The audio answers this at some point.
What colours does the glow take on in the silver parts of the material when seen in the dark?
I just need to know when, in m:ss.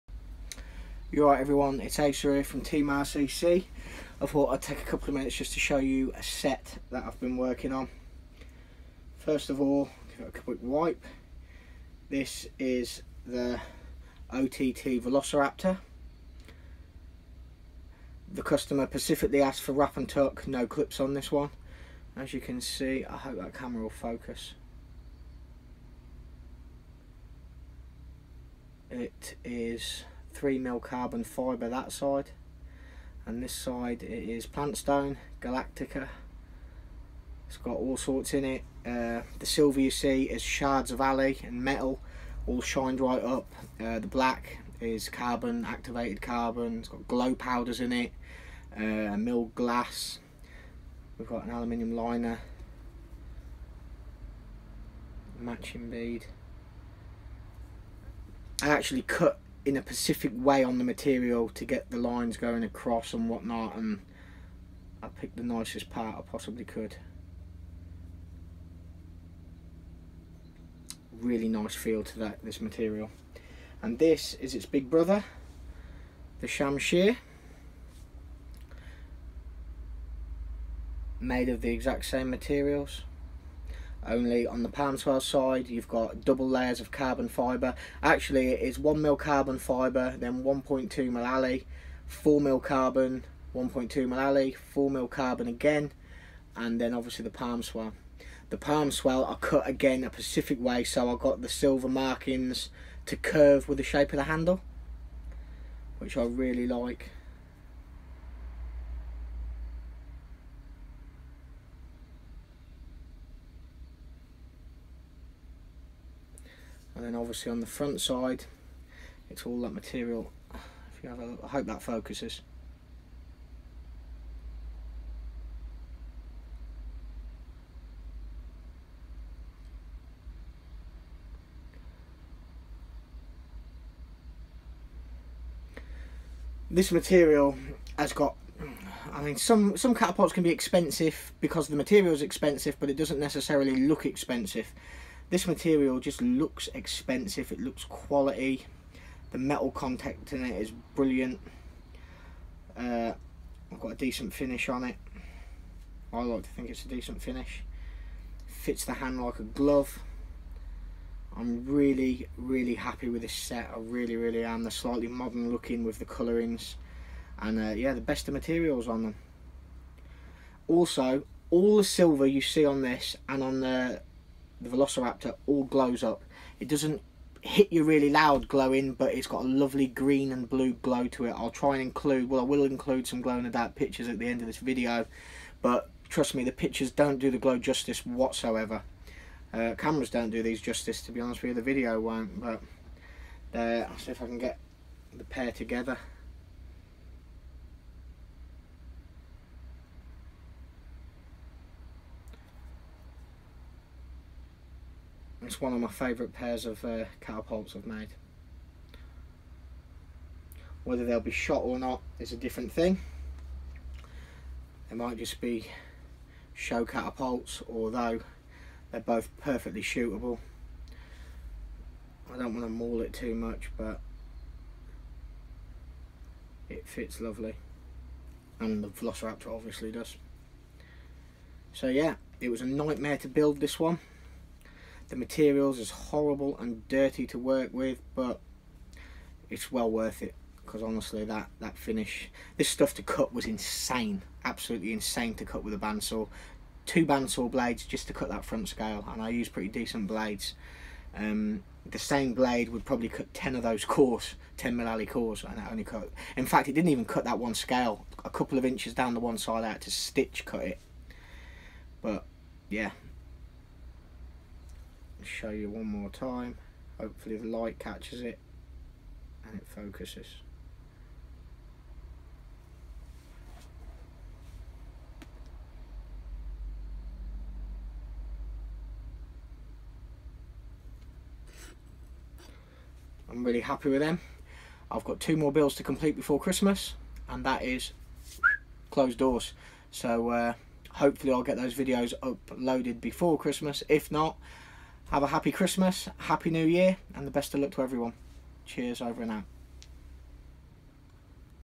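2:59.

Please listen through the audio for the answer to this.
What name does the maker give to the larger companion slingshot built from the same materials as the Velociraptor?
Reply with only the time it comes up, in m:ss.
1:16.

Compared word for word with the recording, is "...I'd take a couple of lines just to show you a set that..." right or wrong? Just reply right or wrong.
wrong.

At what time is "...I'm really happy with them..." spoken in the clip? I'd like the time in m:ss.
4:43.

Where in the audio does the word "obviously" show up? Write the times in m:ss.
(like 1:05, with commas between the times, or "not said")
1:36, 1:57, 3:49.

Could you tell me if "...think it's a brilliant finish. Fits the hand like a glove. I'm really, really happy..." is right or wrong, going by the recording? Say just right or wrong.
wrong.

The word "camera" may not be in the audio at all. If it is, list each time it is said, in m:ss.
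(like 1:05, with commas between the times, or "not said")
0:23, 3:09.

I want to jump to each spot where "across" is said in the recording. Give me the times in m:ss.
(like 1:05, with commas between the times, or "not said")
1:02.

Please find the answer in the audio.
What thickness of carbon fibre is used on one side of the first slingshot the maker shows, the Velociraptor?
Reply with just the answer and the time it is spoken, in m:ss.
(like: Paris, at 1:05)
3 mm, at 0:30.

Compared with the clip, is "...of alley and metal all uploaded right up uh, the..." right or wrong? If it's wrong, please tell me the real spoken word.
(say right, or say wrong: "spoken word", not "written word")
wrong: "shined", not "uploaded".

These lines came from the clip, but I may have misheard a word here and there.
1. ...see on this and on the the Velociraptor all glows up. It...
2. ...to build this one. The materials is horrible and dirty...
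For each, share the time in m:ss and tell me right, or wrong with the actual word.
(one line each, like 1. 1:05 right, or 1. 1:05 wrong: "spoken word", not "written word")
1. 2:52 right
2. 3:53 right.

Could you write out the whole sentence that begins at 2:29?
The metal contact in it is brilliant.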